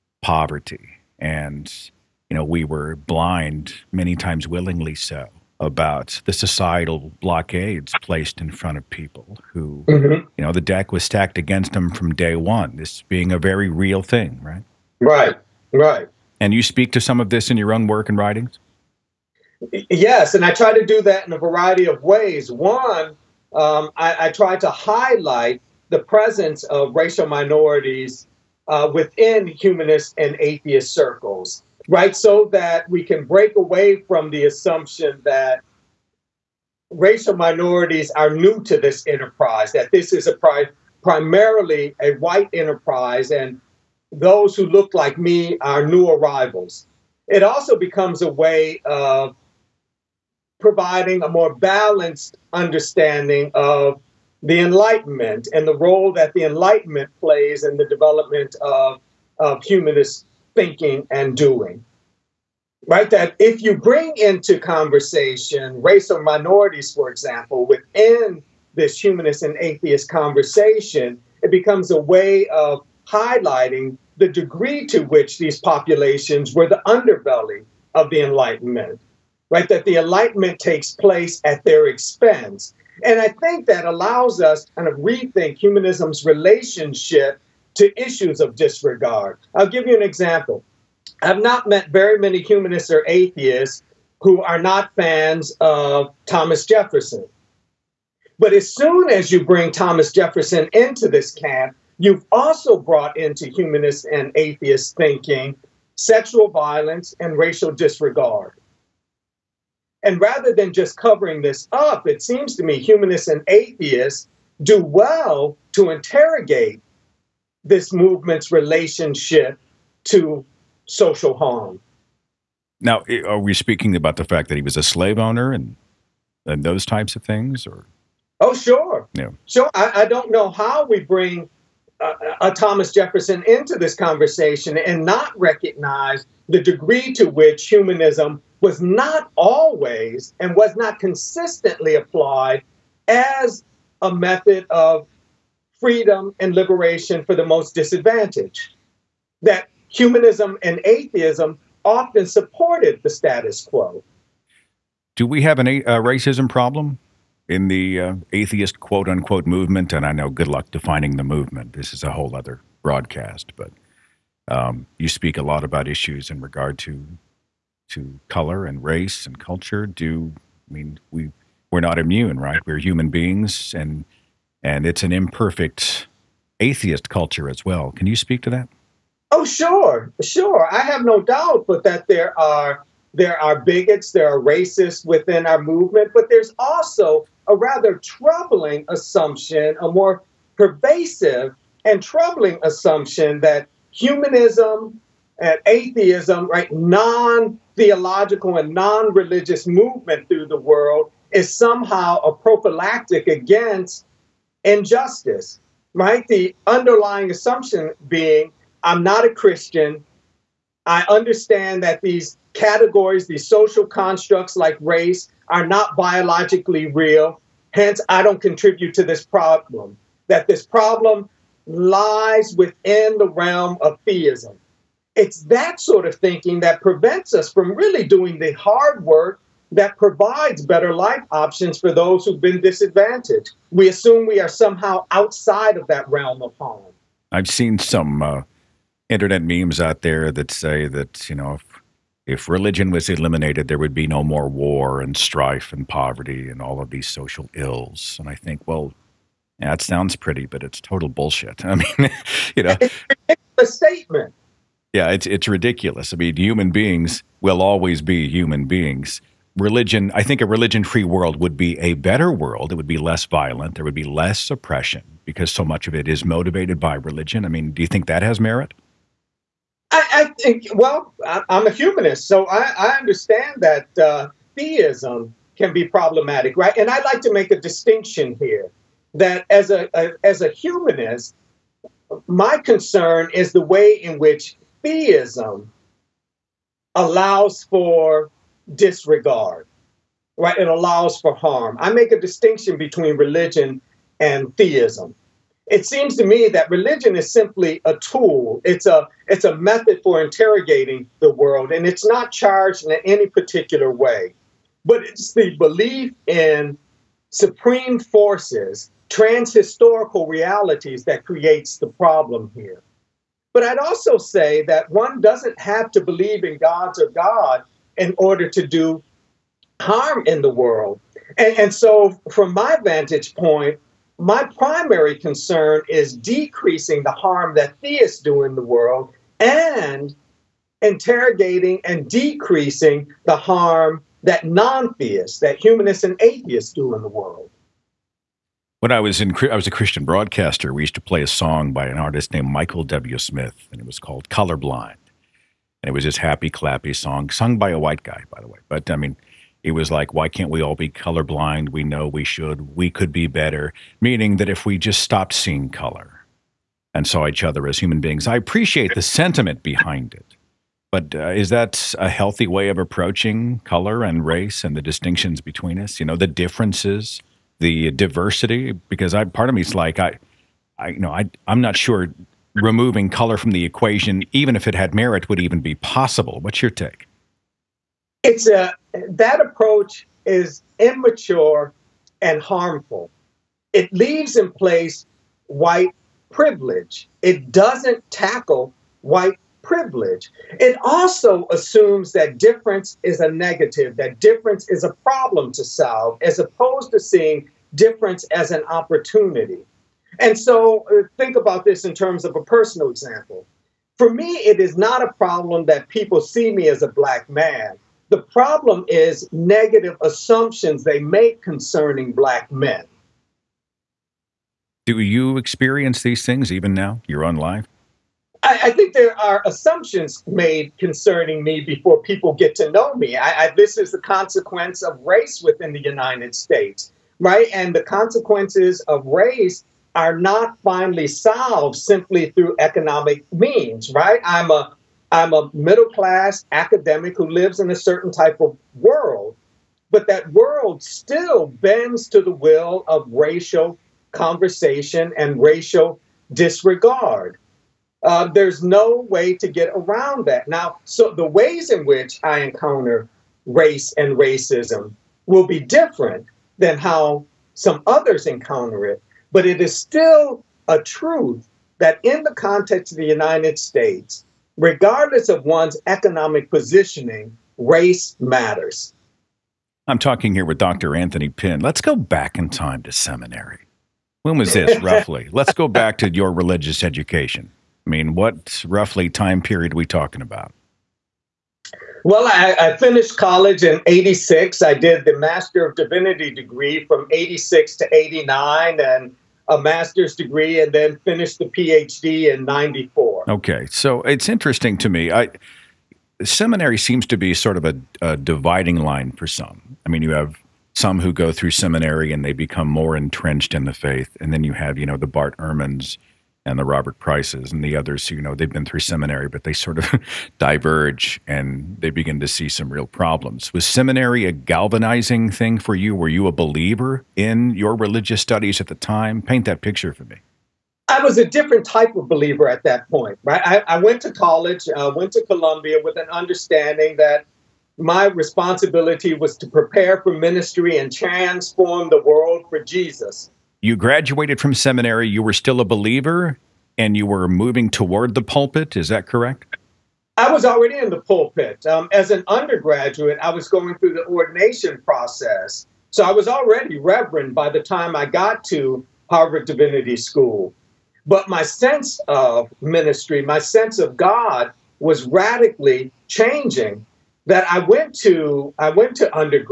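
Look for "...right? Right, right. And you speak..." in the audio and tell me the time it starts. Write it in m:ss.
0:14.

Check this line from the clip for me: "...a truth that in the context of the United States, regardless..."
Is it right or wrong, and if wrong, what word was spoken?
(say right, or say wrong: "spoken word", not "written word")
right.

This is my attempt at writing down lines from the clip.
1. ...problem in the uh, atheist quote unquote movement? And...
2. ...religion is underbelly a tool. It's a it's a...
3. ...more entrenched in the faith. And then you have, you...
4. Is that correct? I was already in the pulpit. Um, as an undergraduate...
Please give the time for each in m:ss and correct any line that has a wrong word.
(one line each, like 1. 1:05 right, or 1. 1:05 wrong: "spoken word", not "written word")
1. 2:36 right
2. 4:56 wrong: "simply", not "underbelly"
3. 8:22 right
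4. 8:58 right.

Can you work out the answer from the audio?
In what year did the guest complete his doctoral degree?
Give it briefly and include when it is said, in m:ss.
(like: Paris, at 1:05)
1994, at 8:12.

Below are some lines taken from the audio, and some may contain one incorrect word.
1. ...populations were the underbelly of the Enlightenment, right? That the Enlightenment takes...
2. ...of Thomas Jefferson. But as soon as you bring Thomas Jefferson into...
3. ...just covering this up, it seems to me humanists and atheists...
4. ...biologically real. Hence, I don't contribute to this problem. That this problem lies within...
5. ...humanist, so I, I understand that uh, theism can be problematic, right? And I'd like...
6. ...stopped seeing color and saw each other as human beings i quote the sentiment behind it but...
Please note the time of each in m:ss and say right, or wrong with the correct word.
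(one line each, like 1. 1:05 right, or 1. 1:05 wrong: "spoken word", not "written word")
1. 1:15 right
2. 1:35 right
3. 1:50 right
4. 3:35 right
5. 4:31 right
6. 5:55 wrong: "appreciate", not "quote".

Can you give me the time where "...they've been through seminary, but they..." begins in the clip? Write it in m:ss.
8:28.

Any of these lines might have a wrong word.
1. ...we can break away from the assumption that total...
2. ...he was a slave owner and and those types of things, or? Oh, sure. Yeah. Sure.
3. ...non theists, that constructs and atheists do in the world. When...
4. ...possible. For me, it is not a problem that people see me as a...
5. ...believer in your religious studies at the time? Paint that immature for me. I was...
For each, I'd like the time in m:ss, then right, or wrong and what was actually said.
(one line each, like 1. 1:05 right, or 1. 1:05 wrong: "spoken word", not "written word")
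1. 0:32 wrong: "racial", not "total"
2. 2:04 right
3. 5:34 wrong: "humanists", not "constructs"
4. 6:42 wrong: "example", not "possible"
5. 8:36 wrong: "picture", not "immature".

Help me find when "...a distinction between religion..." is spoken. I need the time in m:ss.
4:52.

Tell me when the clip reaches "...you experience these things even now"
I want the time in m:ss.
6:54.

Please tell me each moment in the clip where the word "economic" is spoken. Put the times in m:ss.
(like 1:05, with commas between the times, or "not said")
7:12, 7:45.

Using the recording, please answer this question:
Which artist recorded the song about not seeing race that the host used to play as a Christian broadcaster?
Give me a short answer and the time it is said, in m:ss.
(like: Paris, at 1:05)
Michael W. Smith, at 5:42.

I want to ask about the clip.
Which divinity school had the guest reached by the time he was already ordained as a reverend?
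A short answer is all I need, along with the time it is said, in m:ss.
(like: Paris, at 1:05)
Harvard Divinity School, at 9:09.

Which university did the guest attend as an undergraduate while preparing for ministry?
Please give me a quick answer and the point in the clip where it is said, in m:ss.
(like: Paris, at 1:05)
Columbia, at 8:45.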